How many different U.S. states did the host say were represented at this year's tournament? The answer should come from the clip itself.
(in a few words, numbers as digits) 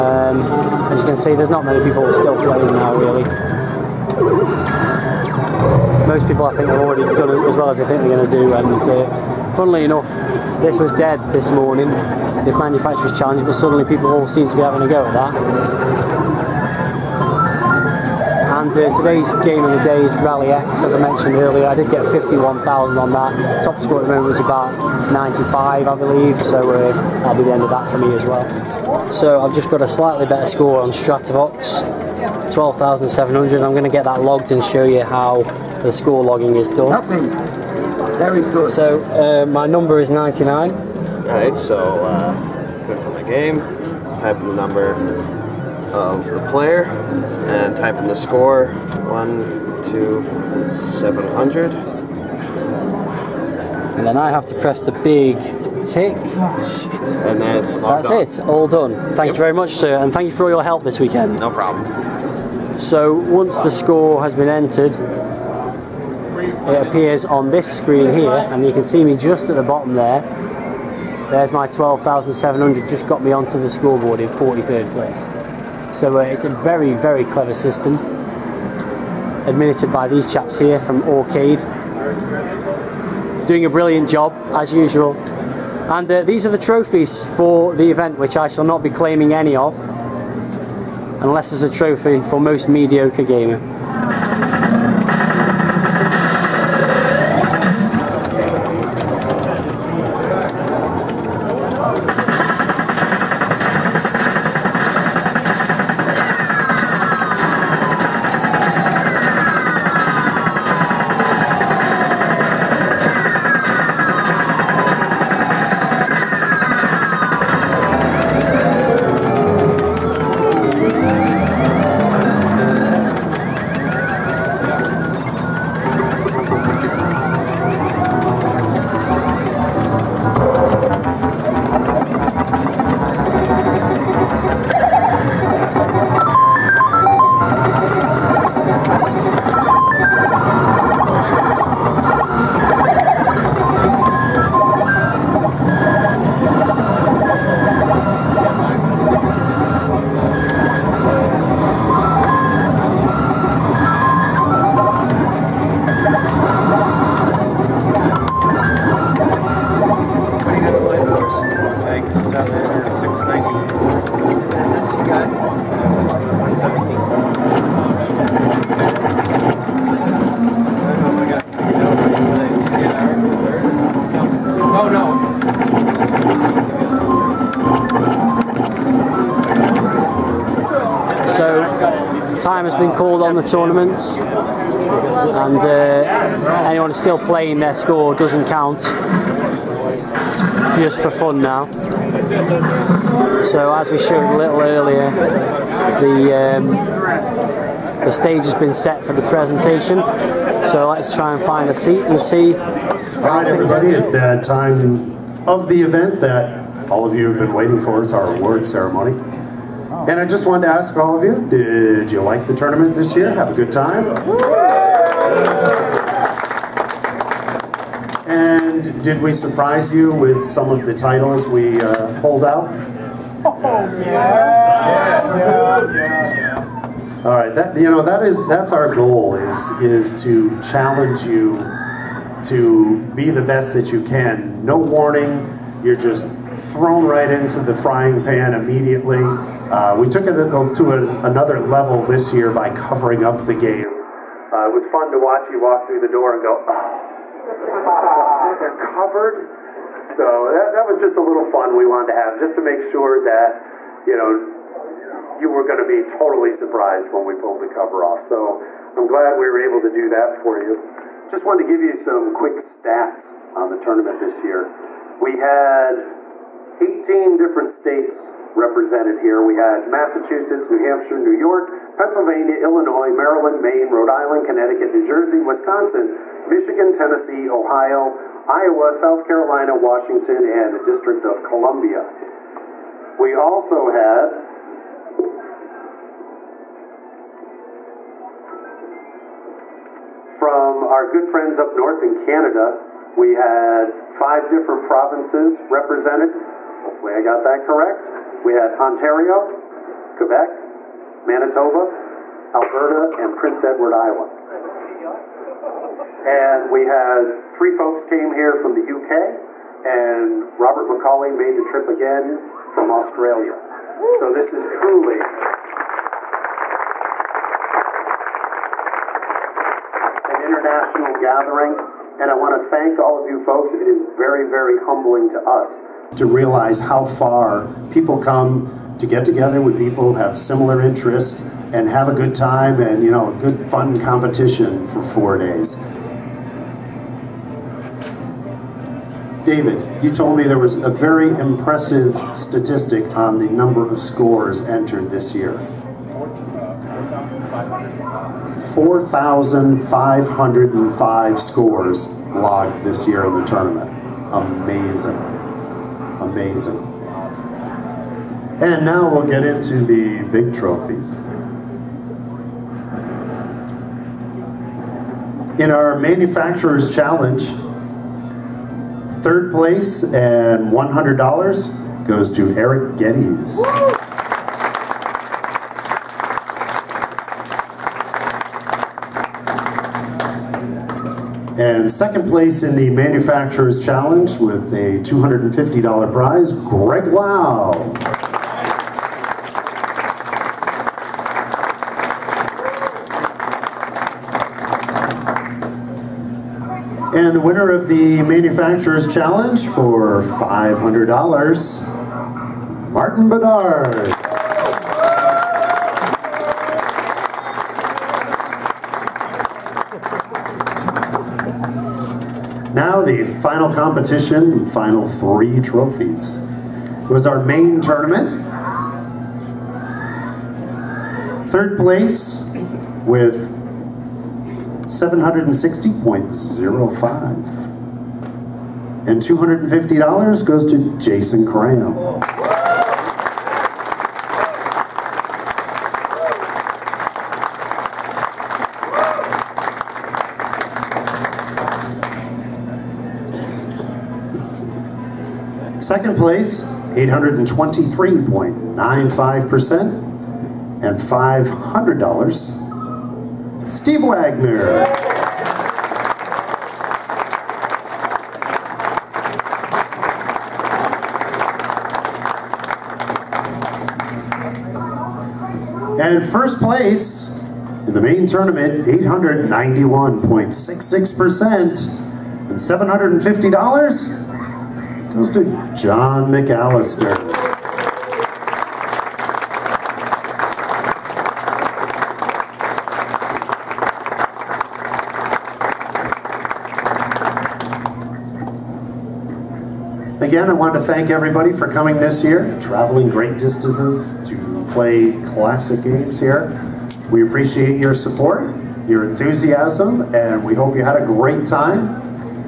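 18.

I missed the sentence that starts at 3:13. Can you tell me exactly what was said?
So as we showed a little earlier, the um, the stage has been set for the presentation.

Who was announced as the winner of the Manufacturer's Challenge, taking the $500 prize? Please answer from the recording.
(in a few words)
Martin Bedard.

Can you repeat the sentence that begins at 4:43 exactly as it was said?
We also had from our good friends up north in Canada, we had five different provinces represented Hopefully I got that correct.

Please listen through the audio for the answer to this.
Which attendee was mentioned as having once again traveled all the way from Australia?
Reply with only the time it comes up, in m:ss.
5:10.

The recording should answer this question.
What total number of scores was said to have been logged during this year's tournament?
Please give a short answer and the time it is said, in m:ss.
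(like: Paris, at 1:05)
4,505, at 5:48.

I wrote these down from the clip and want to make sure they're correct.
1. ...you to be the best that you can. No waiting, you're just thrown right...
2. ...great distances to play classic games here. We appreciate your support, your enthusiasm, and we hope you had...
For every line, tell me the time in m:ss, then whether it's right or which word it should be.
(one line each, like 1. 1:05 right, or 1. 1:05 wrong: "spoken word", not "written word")
1. 3:51 wrong: "warning", not "waiting"
2. 8:13 right.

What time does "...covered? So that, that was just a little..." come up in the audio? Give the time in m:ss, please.
4:08.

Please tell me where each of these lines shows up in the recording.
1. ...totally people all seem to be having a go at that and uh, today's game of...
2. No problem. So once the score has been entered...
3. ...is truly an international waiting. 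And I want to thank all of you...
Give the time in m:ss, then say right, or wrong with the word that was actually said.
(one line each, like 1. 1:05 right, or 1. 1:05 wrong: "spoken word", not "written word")
1. 0:13 wrong: "suddenly", not "totally"
2. 1:01 right
3. 5:14 wrong: "gathering", not "waiting".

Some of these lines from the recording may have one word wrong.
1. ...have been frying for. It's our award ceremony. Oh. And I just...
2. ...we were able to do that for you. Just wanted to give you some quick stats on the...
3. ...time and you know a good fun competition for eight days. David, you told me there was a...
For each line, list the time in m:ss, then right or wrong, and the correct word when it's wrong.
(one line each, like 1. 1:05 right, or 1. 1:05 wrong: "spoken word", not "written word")
1. 3:27 wrong: "waiting", not "frying"
2. 4:19 right
3. 5:32 wrong: "four", not "eight".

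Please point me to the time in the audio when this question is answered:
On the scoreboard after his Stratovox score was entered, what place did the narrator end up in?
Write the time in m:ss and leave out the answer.
1:14.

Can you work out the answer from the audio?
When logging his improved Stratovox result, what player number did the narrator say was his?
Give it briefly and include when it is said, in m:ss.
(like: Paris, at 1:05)
99, at 0:40.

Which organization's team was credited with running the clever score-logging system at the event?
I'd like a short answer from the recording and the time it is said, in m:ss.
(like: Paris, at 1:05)
Aurcade, at 1:21.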